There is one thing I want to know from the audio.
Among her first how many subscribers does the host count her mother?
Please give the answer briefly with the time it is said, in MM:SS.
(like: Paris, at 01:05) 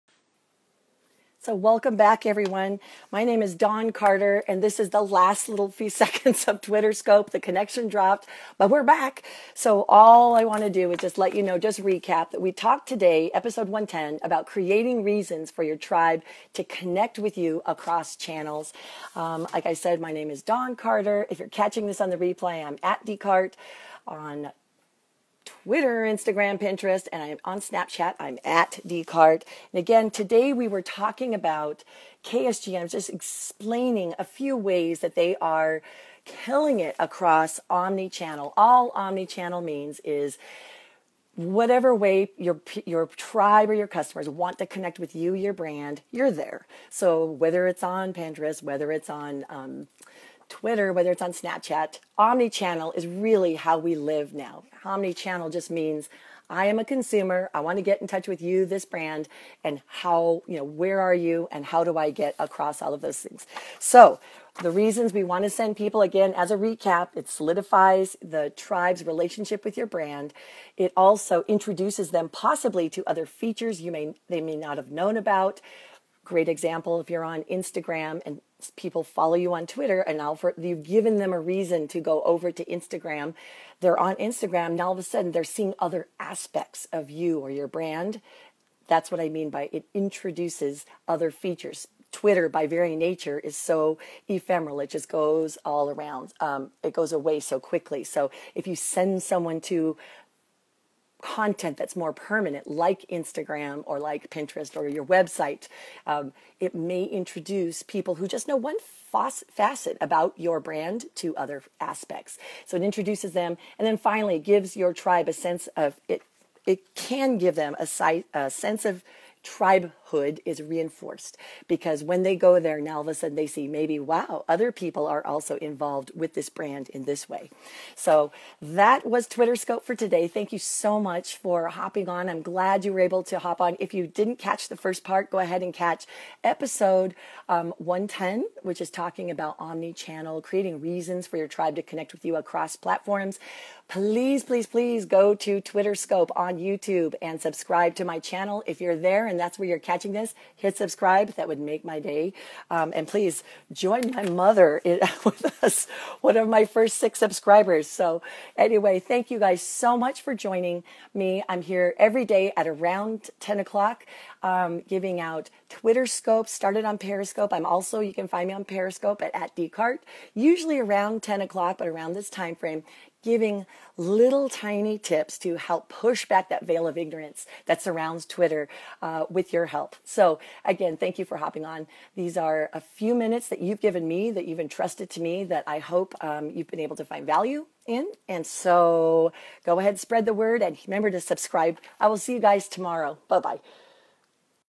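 6, at 02:36.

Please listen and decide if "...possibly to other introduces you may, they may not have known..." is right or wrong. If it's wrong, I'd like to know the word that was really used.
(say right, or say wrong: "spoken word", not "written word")
wrong: "features", not "introduces".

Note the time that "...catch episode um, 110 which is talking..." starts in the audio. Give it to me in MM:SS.
02:15.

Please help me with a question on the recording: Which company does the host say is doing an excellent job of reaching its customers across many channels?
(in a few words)
KSG.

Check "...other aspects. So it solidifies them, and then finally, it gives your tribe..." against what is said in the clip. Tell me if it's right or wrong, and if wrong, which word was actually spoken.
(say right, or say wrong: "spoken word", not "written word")
wrong: "introduces", not "solidifies".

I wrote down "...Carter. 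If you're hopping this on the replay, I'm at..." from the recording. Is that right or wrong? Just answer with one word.
wrong.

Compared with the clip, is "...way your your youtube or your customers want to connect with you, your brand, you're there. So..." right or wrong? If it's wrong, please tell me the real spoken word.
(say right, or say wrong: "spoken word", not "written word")
wrong: "tribe", not "youtube".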